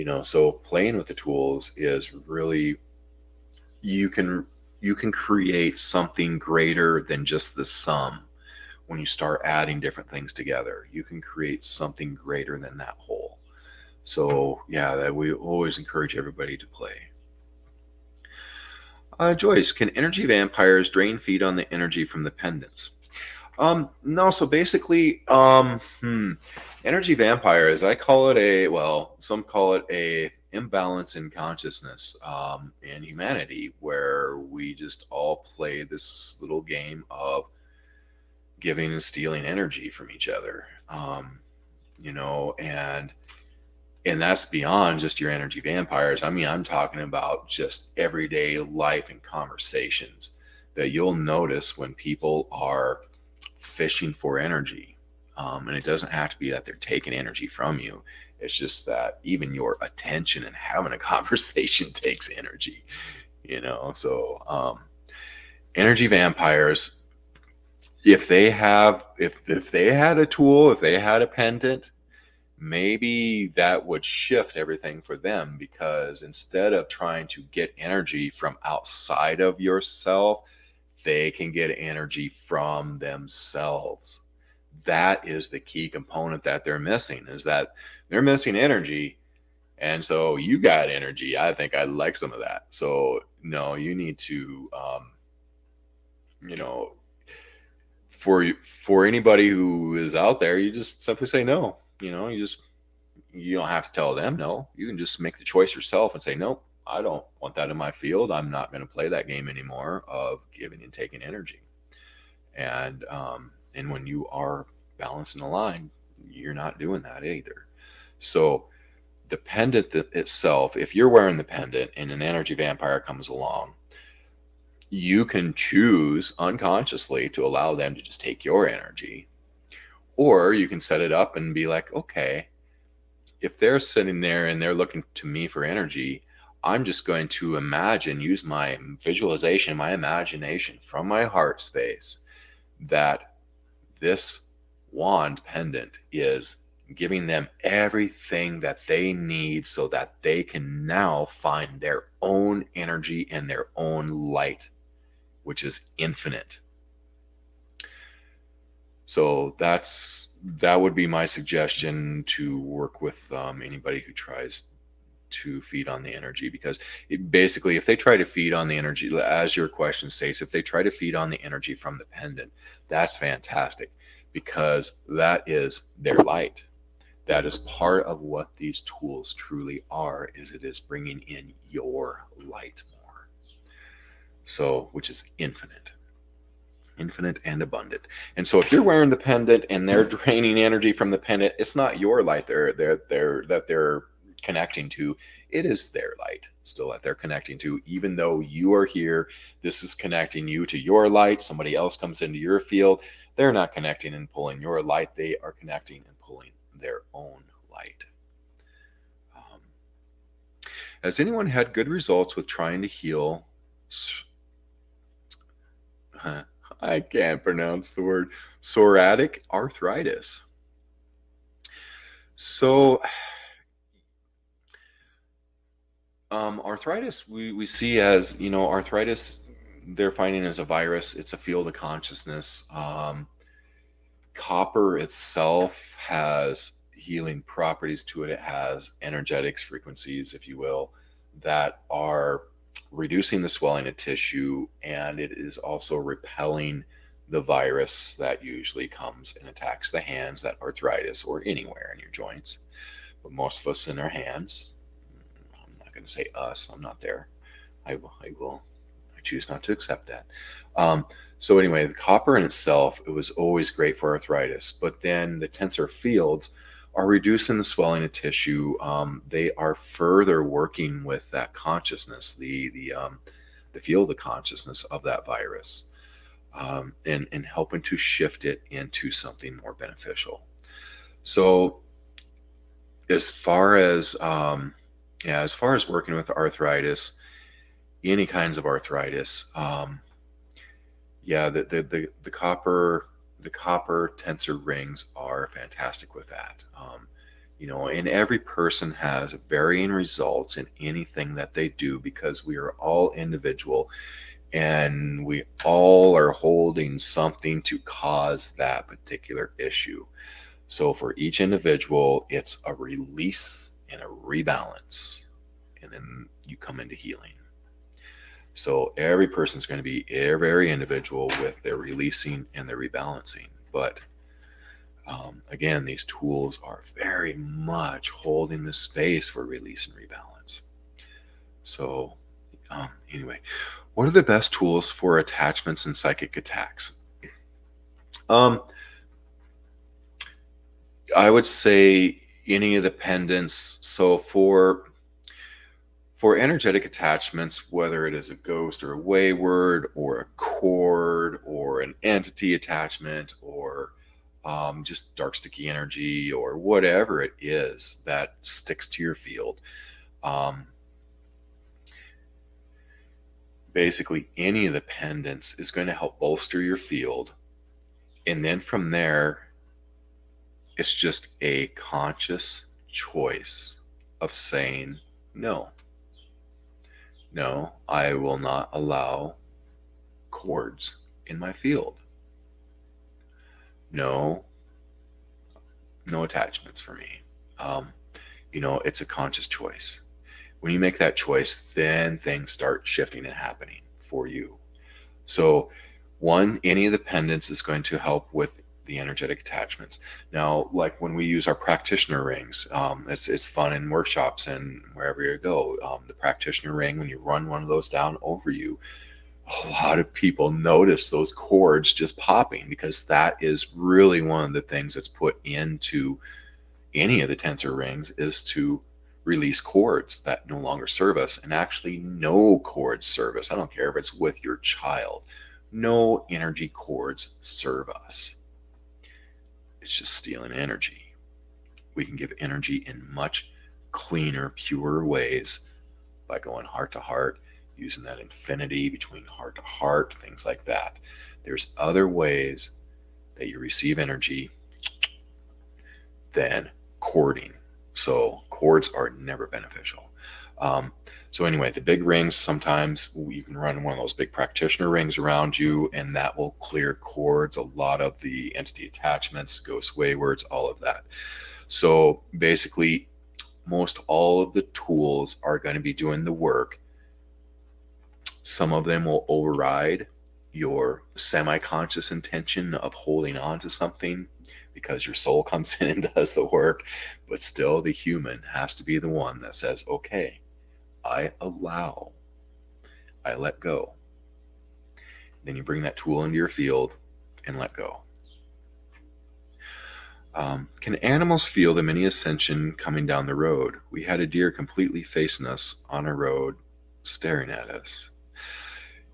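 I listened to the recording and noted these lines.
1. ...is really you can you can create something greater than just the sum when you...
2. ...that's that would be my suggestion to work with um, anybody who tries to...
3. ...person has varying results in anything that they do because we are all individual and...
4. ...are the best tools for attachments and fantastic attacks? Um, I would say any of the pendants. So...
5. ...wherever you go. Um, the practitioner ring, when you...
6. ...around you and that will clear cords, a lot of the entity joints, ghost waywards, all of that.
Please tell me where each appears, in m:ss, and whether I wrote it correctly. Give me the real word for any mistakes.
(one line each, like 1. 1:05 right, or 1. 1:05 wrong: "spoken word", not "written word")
1. 0:01 right
2. 2:39 right
3. 4:58 right
4. 5:34 wrong: "psychic", not "fantastic"
5. 6:44 right
6. 7:35 wrong: "attachments", not "joints".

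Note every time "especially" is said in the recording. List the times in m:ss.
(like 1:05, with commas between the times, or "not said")
not said.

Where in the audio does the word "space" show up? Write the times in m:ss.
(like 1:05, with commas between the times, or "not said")
2:21, 5:28.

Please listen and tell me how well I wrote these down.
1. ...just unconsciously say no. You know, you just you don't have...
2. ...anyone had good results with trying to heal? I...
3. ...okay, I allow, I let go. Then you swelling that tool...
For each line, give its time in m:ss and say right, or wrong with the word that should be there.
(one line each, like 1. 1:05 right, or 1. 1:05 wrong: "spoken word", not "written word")
1. 1:40 wrong: "simply", not "unconsciously"
2. 3:31 right
3. 7:59 wrong: "bring", not "swelling".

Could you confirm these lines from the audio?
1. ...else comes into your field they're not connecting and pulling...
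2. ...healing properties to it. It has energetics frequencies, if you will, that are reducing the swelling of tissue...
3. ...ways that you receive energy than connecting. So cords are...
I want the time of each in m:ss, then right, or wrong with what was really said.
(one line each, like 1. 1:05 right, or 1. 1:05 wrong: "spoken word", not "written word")
1. 3:21 right
2. 3:56 right
3. 7:22 wrong: "cording", not "connecting".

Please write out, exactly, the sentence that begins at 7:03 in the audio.
I don't care if it's with your child.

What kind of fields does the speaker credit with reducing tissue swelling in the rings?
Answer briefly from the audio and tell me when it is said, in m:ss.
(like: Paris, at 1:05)
Tensor fields, at 4:25.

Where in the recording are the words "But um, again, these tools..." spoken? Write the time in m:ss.
5:23.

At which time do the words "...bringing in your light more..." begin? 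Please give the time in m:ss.
3:00.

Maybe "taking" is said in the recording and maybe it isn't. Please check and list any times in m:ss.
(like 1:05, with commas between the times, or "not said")
0:56, 1:50.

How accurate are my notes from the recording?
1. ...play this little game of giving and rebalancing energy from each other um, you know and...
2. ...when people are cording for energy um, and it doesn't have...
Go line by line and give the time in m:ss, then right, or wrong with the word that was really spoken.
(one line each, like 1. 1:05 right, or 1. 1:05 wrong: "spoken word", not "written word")
1. 0:35 wrong: "stealing", not "rebalancing"
2. 0:51 wrong: "fishing", not "cording".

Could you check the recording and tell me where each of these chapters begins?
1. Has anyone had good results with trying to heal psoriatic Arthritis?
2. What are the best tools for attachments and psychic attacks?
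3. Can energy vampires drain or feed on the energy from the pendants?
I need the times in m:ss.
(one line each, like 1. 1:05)
1. 3:30
2. 5:33
3. 0:18.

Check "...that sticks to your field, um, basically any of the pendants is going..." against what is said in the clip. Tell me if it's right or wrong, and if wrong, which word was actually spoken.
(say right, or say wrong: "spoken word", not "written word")
right.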